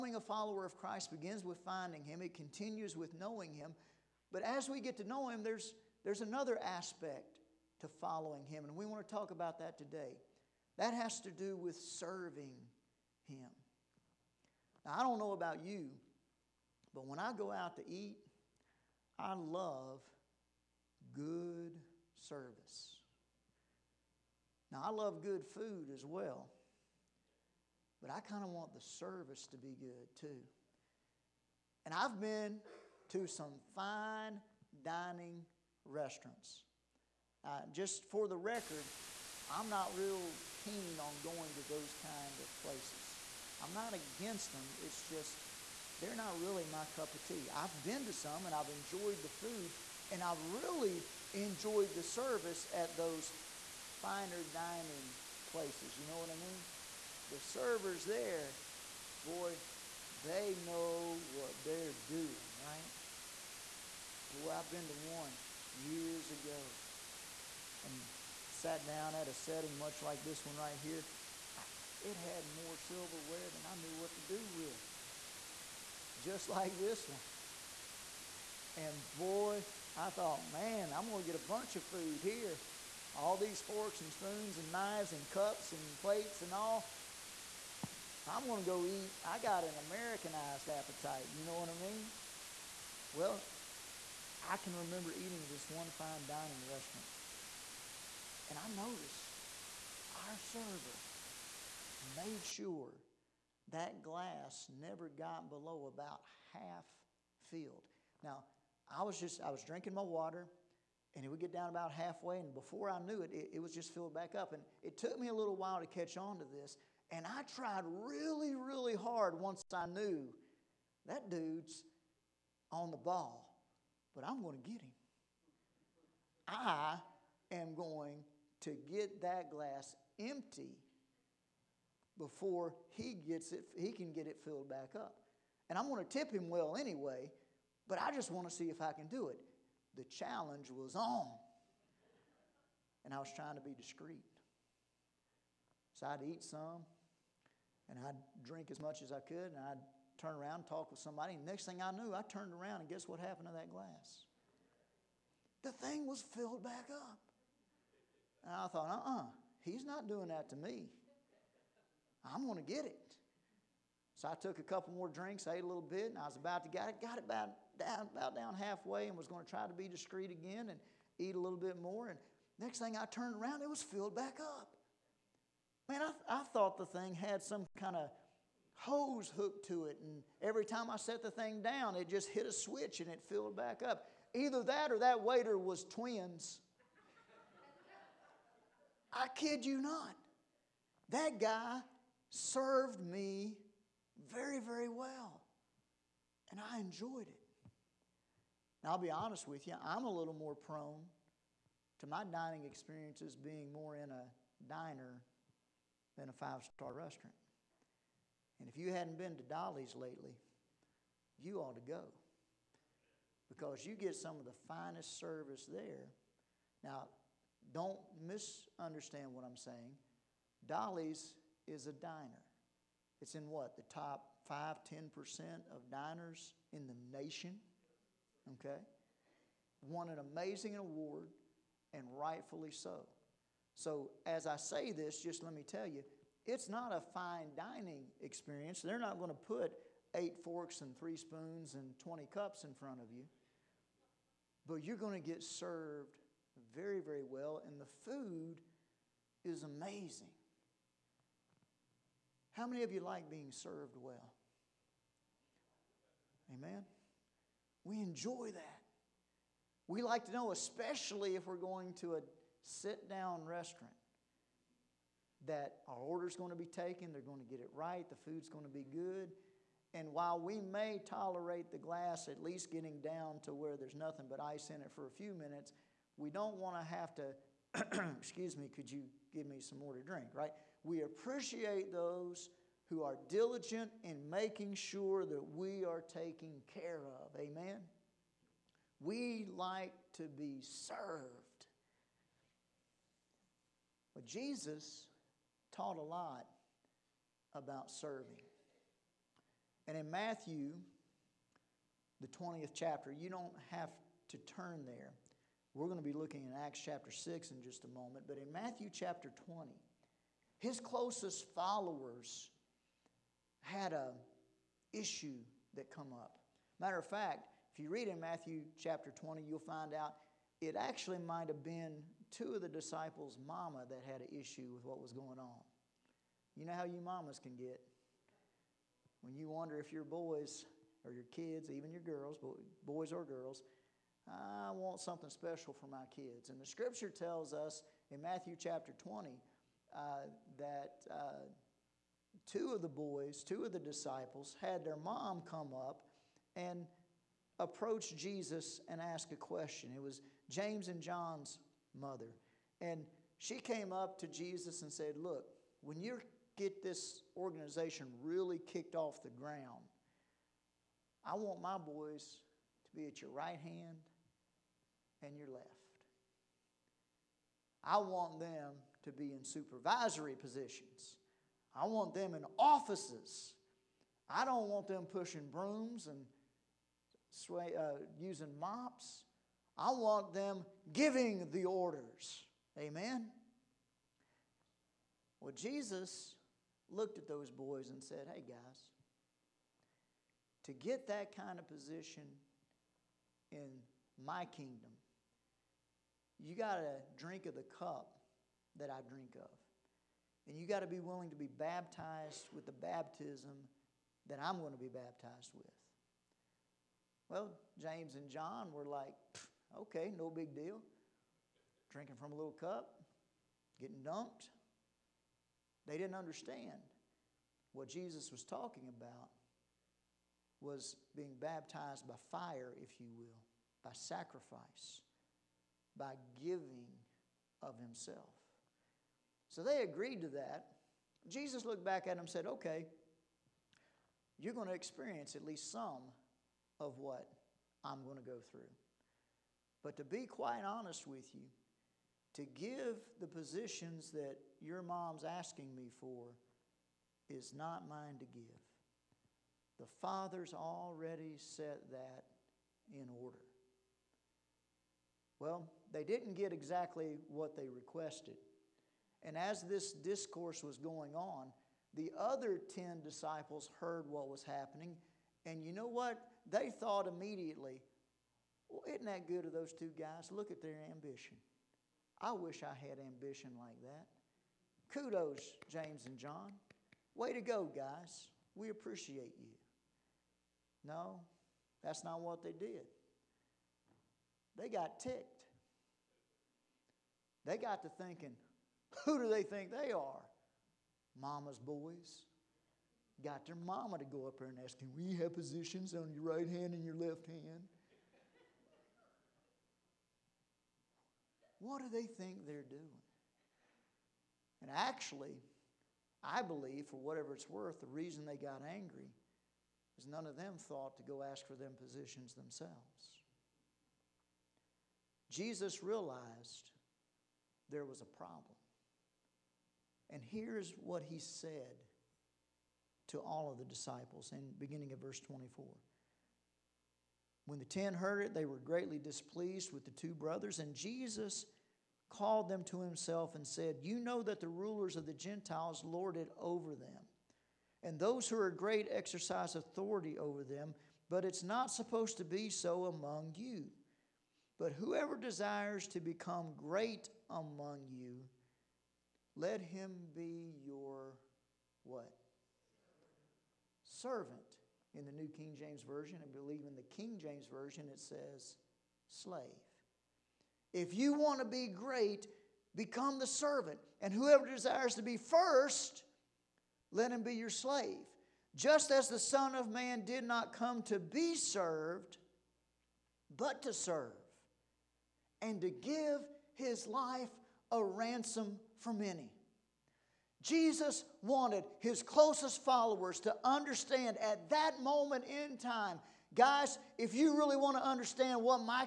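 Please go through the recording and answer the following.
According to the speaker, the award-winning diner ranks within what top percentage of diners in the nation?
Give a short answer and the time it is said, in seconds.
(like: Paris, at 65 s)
top 5 10%, at 223 s.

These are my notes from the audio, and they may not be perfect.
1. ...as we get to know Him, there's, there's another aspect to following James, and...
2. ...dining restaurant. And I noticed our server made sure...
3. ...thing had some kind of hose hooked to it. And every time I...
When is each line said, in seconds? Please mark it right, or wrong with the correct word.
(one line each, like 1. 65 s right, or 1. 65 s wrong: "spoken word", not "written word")
1. 4 s wrong: "Him", not "James"
2. 96 s right
3. 176 s right.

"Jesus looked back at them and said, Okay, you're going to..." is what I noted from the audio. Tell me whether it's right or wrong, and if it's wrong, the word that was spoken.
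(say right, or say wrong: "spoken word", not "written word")
right.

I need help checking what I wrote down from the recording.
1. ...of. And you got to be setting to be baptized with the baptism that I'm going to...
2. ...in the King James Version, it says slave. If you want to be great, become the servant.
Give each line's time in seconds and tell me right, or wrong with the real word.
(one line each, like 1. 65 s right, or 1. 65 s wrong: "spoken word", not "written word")
1. 399 s wrong: "willing", not "setting"
2. 556 s right.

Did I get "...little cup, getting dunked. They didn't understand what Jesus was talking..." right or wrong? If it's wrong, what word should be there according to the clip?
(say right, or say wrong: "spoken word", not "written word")
right.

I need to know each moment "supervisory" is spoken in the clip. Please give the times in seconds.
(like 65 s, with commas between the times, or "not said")
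369 s.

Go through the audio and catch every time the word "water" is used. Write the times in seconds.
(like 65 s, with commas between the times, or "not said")
110 s.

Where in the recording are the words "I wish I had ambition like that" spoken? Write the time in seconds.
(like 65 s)
472 s.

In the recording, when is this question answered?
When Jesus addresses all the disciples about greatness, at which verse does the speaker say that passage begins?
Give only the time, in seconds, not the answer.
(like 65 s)
524 s.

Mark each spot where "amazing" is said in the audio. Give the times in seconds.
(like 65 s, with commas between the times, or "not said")
230 s, 249 s.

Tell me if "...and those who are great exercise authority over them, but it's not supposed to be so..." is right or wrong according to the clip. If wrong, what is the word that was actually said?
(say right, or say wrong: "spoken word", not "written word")
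right.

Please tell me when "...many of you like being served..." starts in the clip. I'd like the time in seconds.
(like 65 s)
252 s.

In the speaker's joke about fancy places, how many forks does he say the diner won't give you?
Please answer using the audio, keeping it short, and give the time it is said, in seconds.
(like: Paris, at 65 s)
8, at 240 s.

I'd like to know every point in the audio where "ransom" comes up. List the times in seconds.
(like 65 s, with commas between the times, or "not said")
577 s.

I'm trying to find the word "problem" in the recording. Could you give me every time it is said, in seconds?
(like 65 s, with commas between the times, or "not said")
518 s.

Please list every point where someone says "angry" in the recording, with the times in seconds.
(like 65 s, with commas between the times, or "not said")
508 s.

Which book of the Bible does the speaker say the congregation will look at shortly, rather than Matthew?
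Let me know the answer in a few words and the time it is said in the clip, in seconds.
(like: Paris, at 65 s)
Acts, at 306 s.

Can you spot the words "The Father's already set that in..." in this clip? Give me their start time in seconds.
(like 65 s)
449 s.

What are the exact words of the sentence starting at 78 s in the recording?
And boy, I thought, man, I'm going to get a bunch of food here.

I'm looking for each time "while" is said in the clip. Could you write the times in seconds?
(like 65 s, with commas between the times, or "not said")
115 s, 270 s.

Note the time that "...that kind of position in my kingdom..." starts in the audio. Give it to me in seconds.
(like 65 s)
391 s.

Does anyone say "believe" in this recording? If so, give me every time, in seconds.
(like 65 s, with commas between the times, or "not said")
506 s, 556 s.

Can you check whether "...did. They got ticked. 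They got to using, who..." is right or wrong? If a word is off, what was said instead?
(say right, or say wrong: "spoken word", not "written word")
wrong: "thinking", not "using".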